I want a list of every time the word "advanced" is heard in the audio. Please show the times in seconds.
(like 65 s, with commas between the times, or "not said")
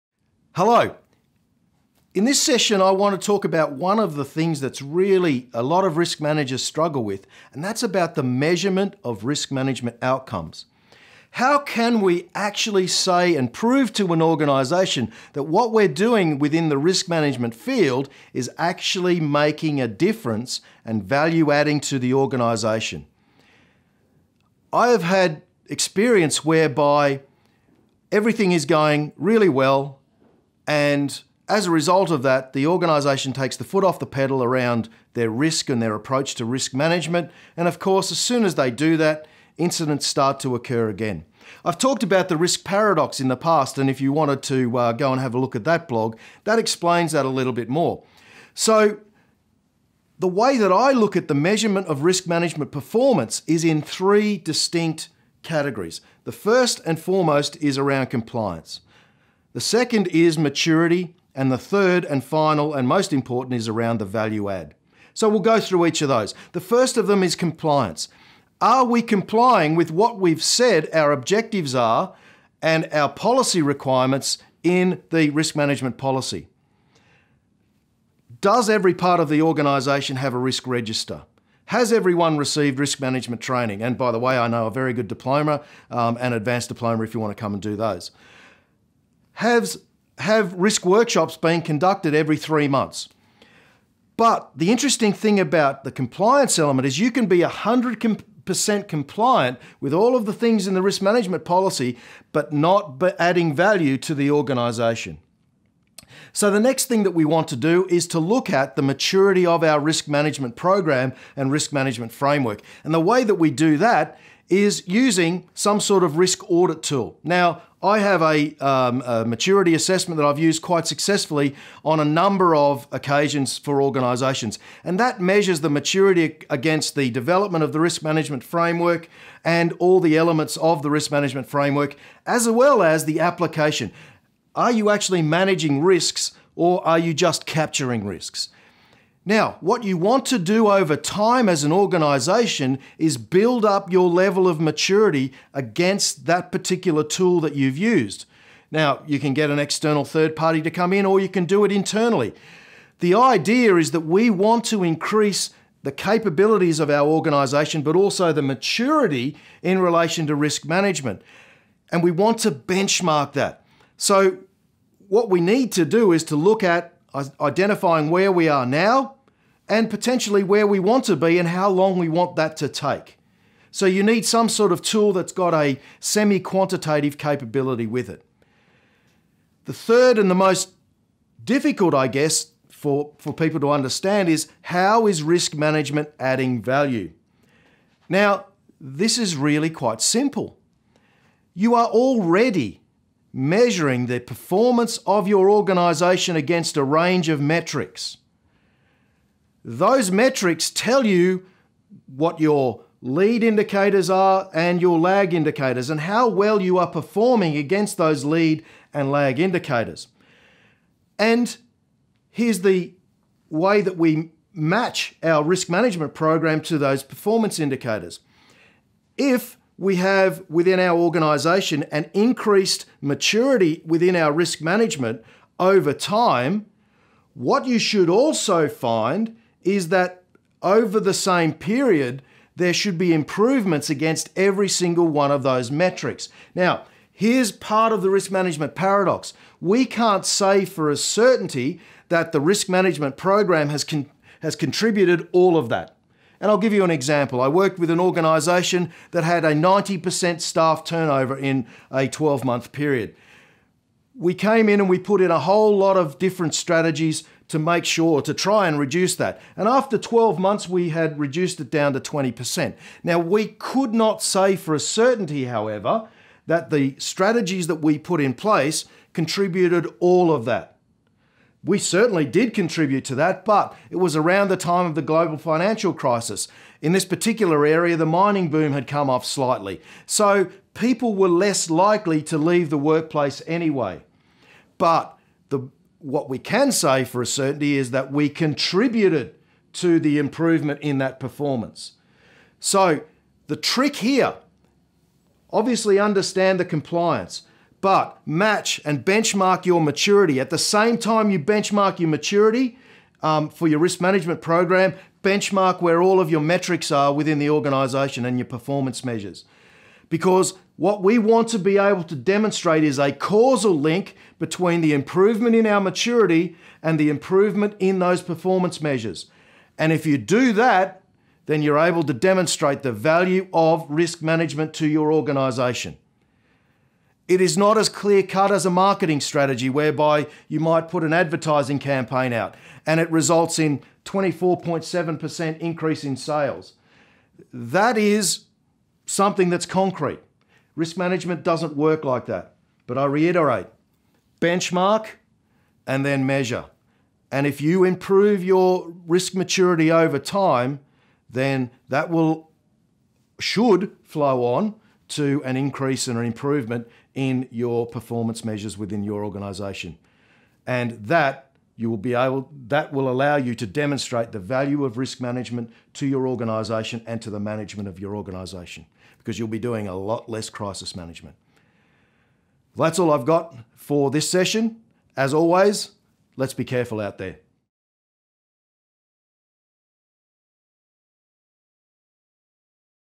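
86 s.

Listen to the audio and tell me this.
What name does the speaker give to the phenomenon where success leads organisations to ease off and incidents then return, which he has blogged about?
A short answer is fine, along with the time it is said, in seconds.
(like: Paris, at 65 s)
risk paradox, at 42 s.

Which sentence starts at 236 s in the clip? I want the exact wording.
Now, here's part of the risk management paradox.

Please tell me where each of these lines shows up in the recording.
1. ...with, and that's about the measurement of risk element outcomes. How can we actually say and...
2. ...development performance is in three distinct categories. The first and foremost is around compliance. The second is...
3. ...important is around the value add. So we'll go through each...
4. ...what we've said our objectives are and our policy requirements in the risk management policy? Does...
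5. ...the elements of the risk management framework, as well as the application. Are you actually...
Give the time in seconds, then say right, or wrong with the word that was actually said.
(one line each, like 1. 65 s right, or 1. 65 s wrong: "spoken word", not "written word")
1. 7 s wrong: "management", not "element"
2. 52 s wrong: "management", not "development"
3. 63 s right
4. 69 s right
5. 130 s right.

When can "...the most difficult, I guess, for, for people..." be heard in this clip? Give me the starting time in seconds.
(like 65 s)
180 s.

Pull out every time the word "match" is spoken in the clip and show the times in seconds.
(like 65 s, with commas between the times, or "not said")
214 s, 298 s.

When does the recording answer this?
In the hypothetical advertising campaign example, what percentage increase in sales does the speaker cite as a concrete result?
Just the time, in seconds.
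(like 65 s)
334 s.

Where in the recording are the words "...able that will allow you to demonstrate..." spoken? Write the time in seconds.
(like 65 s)
362 s.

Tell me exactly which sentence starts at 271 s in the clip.
We certainly did contribute to that, but it was around the time of the global financial crisis.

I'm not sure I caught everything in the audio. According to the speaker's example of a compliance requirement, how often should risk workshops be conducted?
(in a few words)
every 3 months.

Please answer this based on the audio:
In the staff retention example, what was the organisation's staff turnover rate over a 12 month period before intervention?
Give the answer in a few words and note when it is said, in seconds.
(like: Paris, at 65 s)
90%, at 249 s.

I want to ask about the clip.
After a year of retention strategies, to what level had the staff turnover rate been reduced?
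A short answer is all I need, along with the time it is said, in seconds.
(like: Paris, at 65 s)
20%, at 261 s.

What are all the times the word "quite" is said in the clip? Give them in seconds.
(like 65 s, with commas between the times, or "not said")
120 s, 189 s.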